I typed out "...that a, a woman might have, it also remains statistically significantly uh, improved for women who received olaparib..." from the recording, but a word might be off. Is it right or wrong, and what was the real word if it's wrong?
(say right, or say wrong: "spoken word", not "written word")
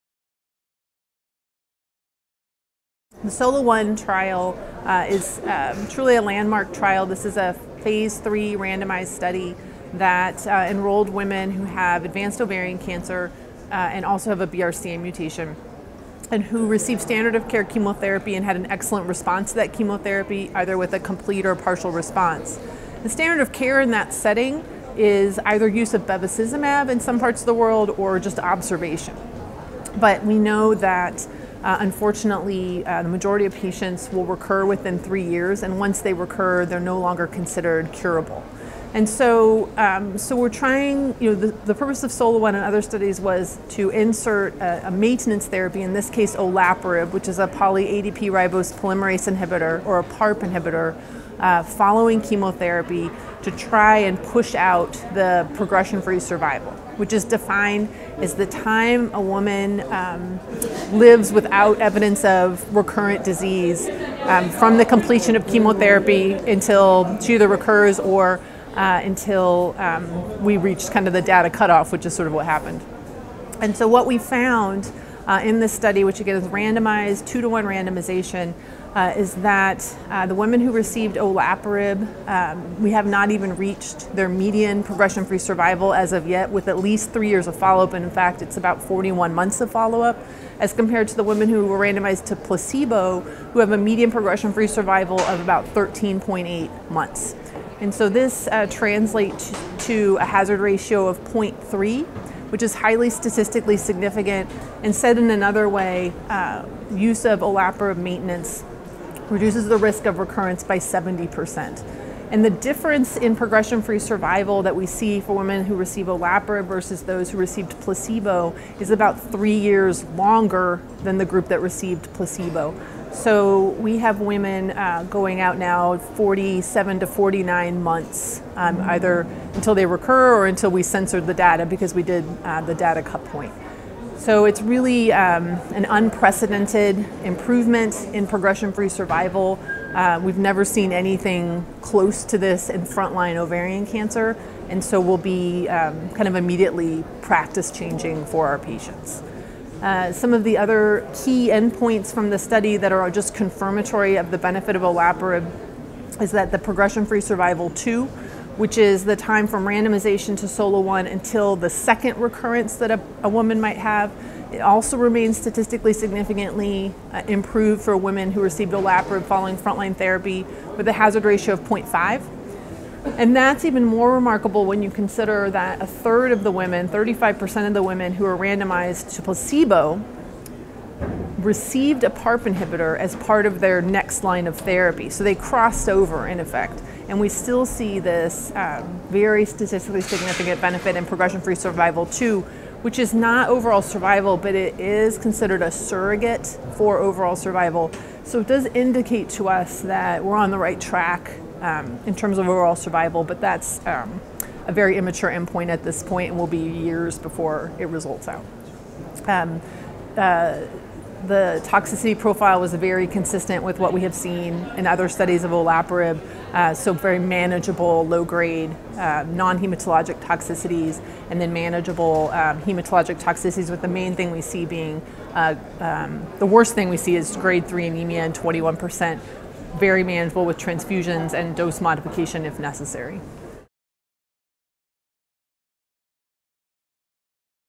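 right.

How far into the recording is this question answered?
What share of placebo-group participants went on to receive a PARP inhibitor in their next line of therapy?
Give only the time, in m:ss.
2:56.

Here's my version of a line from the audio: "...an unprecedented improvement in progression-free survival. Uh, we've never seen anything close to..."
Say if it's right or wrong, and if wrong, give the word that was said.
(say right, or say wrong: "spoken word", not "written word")
right.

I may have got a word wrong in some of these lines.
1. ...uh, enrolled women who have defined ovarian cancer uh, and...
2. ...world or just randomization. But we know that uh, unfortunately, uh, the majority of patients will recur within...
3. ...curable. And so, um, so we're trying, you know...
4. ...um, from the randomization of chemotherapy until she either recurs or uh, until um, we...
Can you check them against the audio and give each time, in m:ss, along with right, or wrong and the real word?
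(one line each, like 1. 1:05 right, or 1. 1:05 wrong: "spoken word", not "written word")
1. 0:10 wrong: "advanced", not "defined"
2. 0:27 wrong: "observation", not "randomization"
3. 0:37 right
4. 1:04 wrong: "completion", not "randomization".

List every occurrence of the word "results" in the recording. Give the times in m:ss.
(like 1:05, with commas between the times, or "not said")
3:27.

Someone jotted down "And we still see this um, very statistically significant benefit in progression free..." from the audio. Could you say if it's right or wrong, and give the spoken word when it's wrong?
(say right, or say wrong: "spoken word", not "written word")
right.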